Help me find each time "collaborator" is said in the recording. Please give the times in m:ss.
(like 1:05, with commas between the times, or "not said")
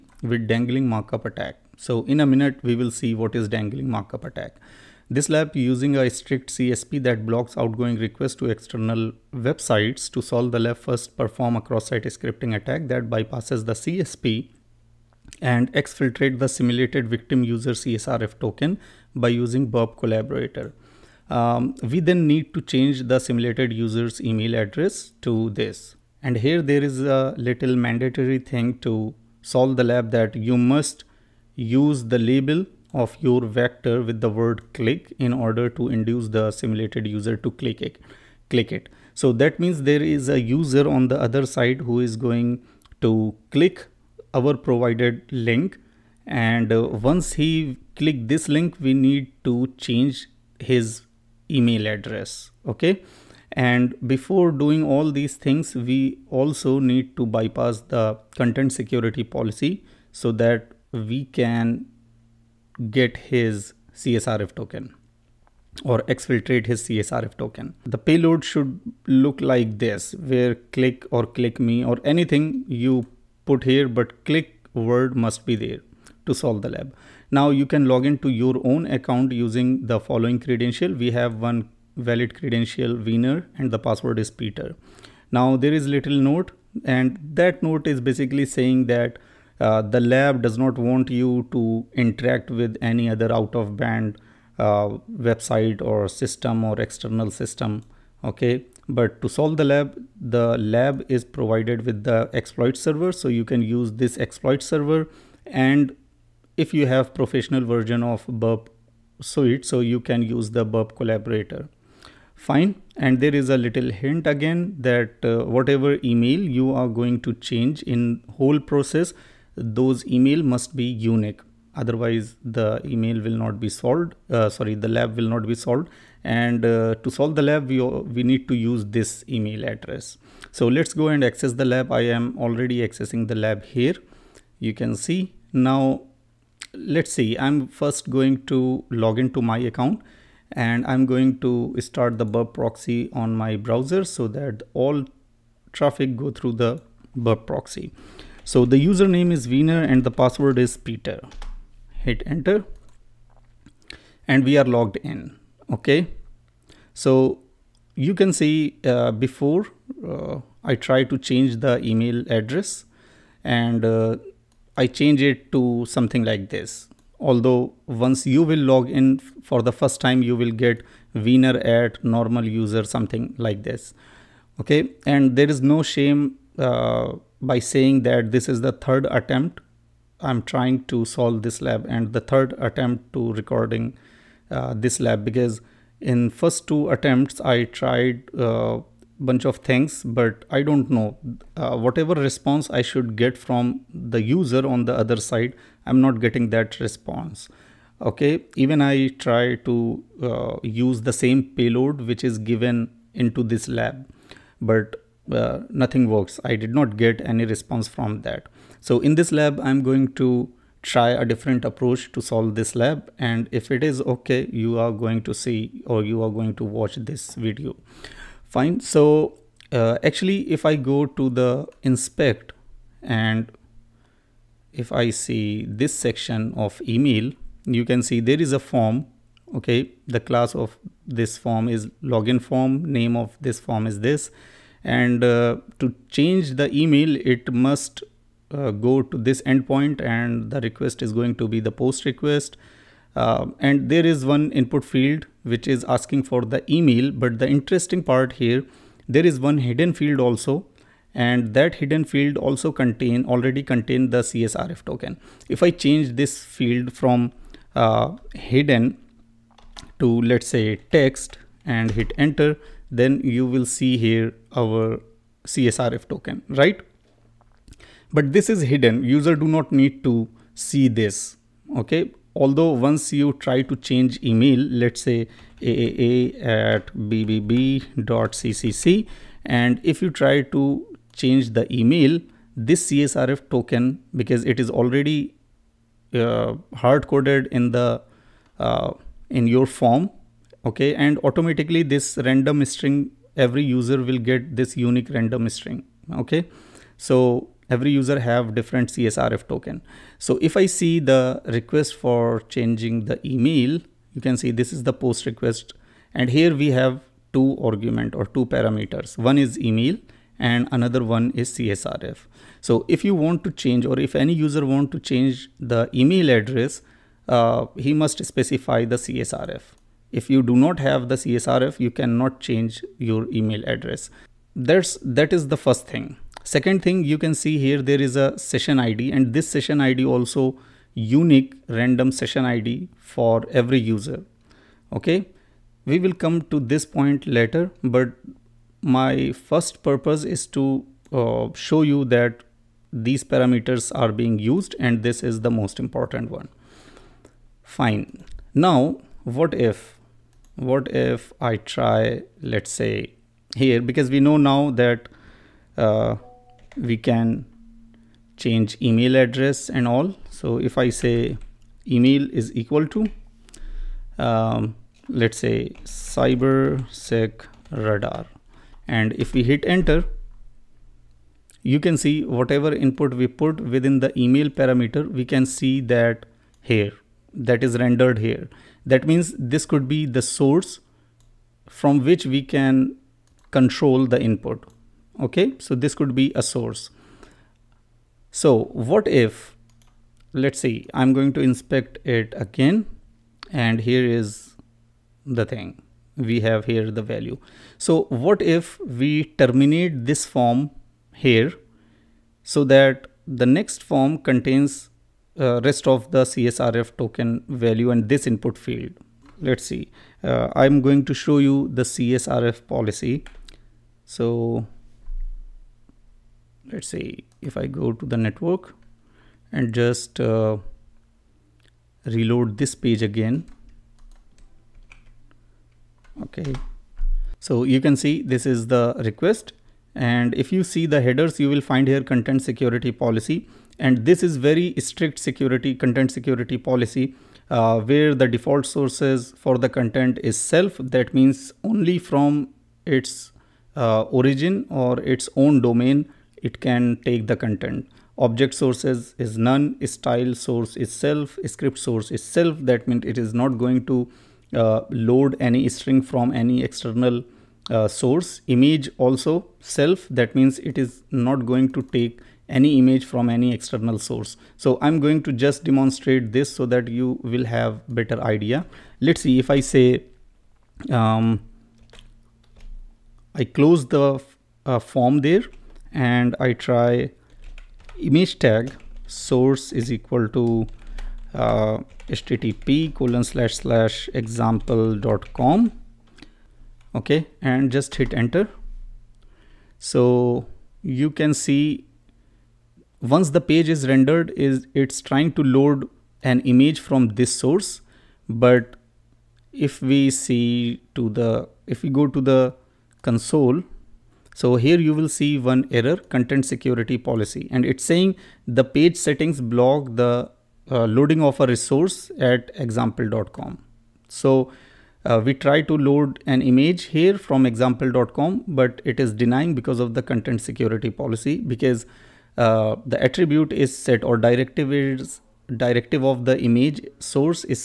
0:19, 1:50.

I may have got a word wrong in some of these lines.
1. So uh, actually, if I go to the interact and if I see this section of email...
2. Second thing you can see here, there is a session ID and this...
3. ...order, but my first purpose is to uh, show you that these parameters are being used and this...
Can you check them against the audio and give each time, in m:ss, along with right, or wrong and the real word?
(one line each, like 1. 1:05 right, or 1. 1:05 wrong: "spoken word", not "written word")
1. 3:38 wrong: "inspect", not "interact"
2. 5:26 right
3. 5:37 wrong: "later", not "order".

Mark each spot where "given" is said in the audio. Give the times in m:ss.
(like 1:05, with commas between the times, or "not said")
3:22.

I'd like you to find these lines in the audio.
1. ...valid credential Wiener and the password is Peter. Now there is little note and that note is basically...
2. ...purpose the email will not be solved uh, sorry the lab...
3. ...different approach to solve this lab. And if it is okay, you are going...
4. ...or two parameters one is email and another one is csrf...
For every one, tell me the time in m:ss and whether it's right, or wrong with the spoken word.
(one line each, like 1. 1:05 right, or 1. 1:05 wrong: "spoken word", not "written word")
1. 1:21 right
2. 2:01 wrong: "otherwise", not "purpose"
3. 3:31 right
4. 5:08 right.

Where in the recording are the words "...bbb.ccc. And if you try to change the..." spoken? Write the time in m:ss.
4:37.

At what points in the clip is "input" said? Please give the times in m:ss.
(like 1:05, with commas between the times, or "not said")
4:04, 6:12, 6:24, 6:48.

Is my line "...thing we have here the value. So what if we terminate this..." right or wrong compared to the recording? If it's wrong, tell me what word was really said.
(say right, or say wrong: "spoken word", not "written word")
right.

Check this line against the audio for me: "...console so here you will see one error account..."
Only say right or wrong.
wrong.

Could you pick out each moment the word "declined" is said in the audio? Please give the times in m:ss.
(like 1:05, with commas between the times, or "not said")
not said.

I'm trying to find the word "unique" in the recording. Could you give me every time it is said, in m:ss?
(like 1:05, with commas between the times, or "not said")
2:00, 4:54, 5:30.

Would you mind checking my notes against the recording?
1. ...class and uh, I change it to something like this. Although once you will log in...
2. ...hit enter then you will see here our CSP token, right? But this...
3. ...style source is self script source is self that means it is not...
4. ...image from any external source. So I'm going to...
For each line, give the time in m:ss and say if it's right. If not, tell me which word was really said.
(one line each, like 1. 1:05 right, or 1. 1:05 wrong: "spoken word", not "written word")
1. 2:42 wrong: "address", not "class"
2. 4:21 wrong: "CSRF", not "CSP"
3. 7:29 right
4. 7:42 right.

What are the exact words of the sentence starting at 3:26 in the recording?
I did not get any response from that.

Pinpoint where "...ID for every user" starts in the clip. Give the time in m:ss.
5:32.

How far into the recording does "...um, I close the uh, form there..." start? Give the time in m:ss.
7:50.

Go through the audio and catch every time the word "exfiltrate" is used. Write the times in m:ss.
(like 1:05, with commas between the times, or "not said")
0:15, 1:06.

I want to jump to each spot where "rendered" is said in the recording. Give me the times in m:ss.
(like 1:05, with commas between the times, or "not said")
6:17, 8:13.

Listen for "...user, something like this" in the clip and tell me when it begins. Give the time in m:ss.
2:52.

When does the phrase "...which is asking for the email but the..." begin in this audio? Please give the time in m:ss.
4:05.